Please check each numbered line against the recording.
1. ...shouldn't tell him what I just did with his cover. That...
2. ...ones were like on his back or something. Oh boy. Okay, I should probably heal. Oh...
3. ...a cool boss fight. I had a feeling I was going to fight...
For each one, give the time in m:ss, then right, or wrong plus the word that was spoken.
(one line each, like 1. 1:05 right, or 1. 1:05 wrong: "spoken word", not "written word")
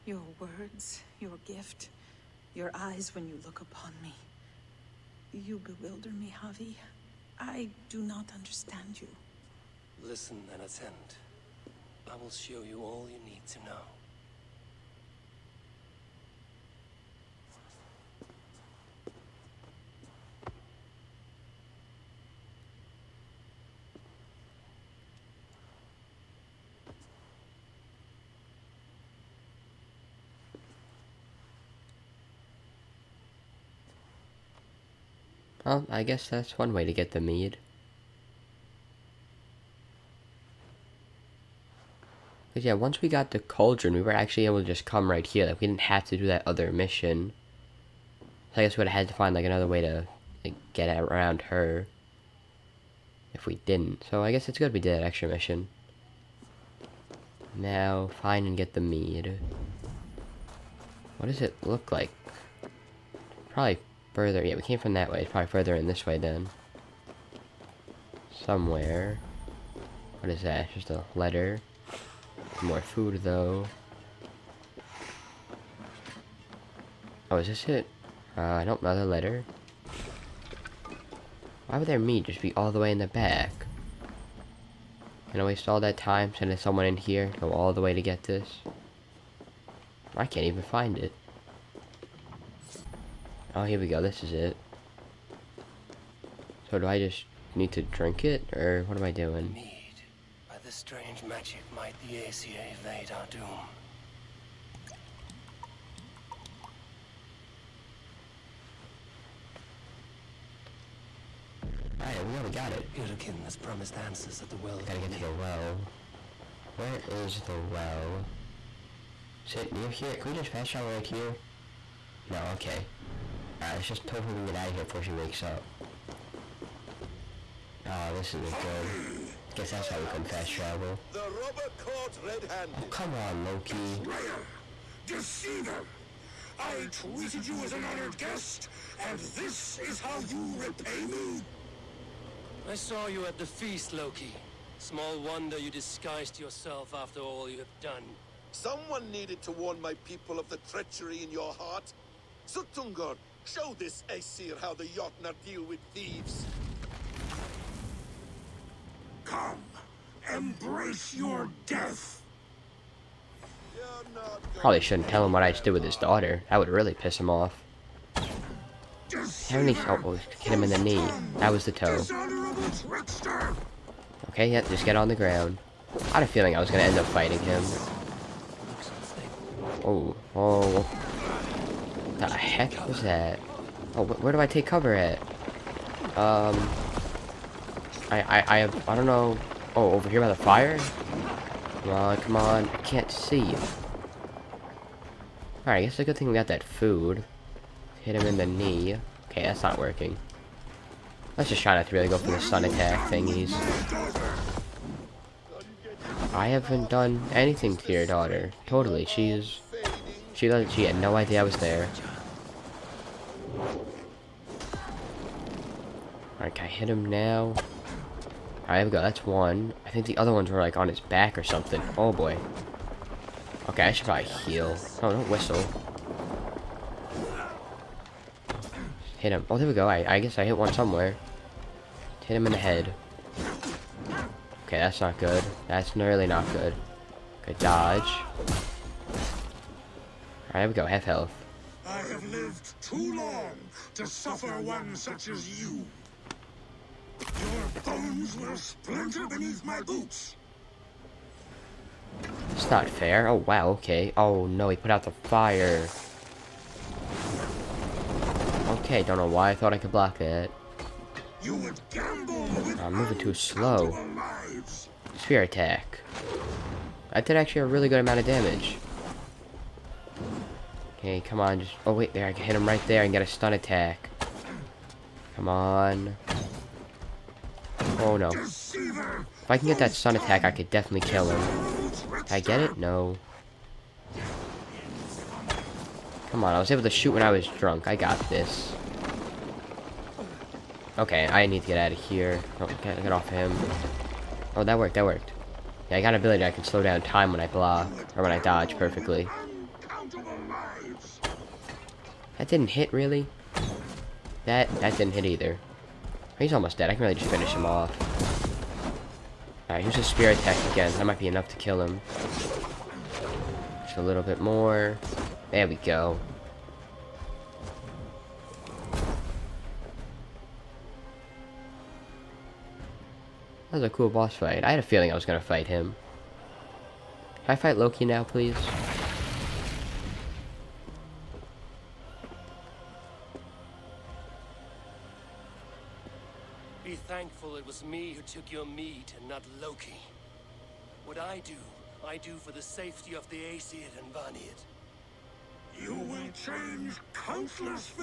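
1. 2:44 wrong: "daughter", not "cover"
2. 3:40 right
3. 5:23 right.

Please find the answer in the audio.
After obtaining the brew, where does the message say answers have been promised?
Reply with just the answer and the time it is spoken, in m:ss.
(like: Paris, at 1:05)
At the well, at 1:54.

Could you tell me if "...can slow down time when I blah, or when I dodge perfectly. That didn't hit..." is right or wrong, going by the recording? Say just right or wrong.
right.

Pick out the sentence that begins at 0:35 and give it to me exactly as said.
Well, I guess that's one way to get the mead.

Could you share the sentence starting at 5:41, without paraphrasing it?
What I do, I do for the safety of the Aesir and Vanir.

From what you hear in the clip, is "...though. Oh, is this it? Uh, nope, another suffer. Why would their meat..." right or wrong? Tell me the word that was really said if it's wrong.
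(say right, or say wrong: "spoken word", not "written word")
wrong: "letter", not "suffer".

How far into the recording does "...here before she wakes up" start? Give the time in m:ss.
2:04.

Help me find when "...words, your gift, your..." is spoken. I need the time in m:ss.
0:00.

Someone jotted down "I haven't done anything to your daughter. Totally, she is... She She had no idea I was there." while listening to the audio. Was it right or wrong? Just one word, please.
right.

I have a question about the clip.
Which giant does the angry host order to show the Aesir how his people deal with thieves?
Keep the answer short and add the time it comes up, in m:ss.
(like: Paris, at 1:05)
Suttungur, at 2:32.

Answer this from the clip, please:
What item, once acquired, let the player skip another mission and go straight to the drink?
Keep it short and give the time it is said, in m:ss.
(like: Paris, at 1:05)
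The cauldron, at 0:43.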